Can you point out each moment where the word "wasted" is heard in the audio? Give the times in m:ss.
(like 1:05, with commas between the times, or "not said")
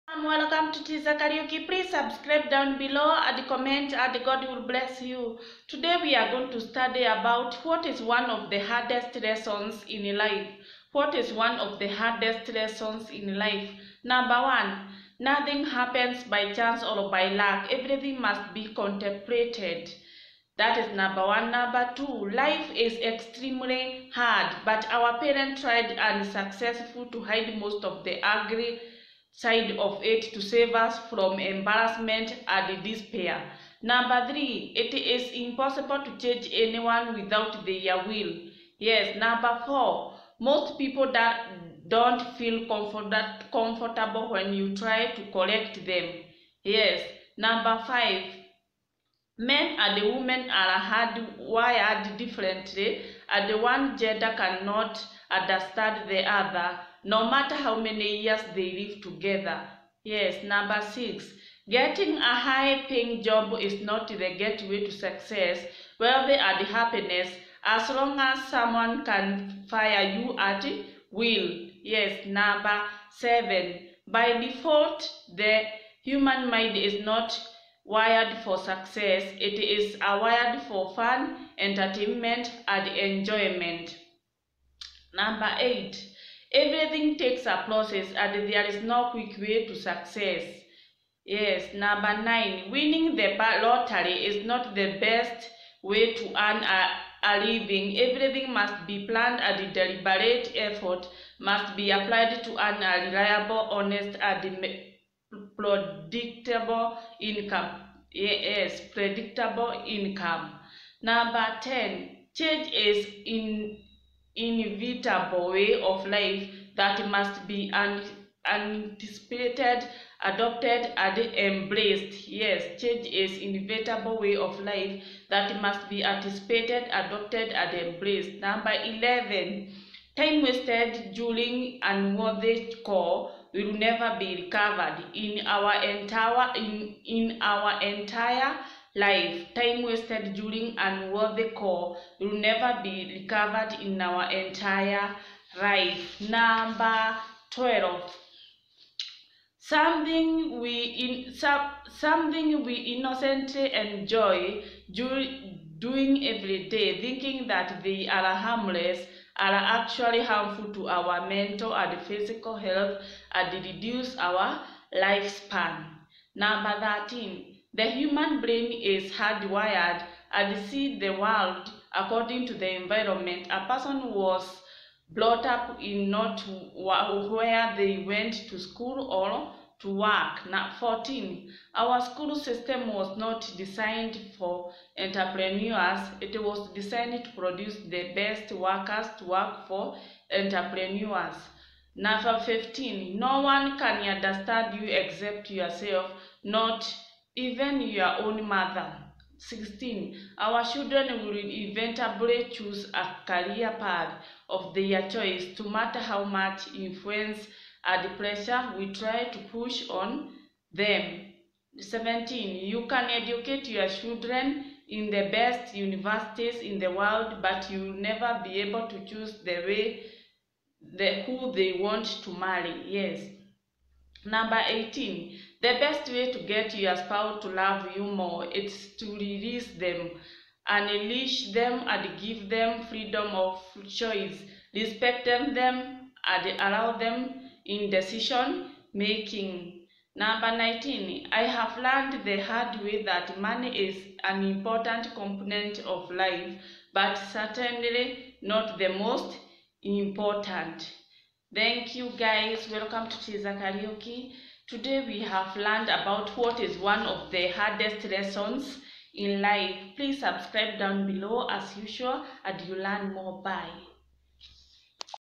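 2:10, 2:19.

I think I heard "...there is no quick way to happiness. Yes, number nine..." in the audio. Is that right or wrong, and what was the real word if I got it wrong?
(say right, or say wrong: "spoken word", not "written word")
wrong: "success", not "happiness".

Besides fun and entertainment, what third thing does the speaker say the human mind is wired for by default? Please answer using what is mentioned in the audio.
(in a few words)
enjoyment.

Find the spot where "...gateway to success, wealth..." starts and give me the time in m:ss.
1:04.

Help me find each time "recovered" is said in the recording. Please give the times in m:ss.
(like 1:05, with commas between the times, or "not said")
2:14, 2:23.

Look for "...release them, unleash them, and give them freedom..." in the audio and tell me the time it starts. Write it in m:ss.
3:49.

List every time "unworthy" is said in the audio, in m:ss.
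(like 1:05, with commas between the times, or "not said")
2:11, 2:20.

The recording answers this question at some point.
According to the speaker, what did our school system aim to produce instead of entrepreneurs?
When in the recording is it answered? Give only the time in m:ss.
3:07.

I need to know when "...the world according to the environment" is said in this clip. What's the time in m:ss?
2:50.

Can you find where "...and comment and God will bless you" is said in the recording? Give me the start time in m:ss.
0:03.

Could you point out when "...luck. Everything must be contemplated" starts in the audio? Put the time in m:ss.
0:17.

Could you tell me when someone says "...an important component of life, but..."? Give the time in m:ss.
4:04.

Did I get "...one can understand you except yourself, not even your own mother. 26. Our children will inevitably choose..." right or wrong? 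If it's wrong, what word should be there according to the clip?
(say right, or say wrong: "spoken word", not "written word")
wrong: "16", not "26".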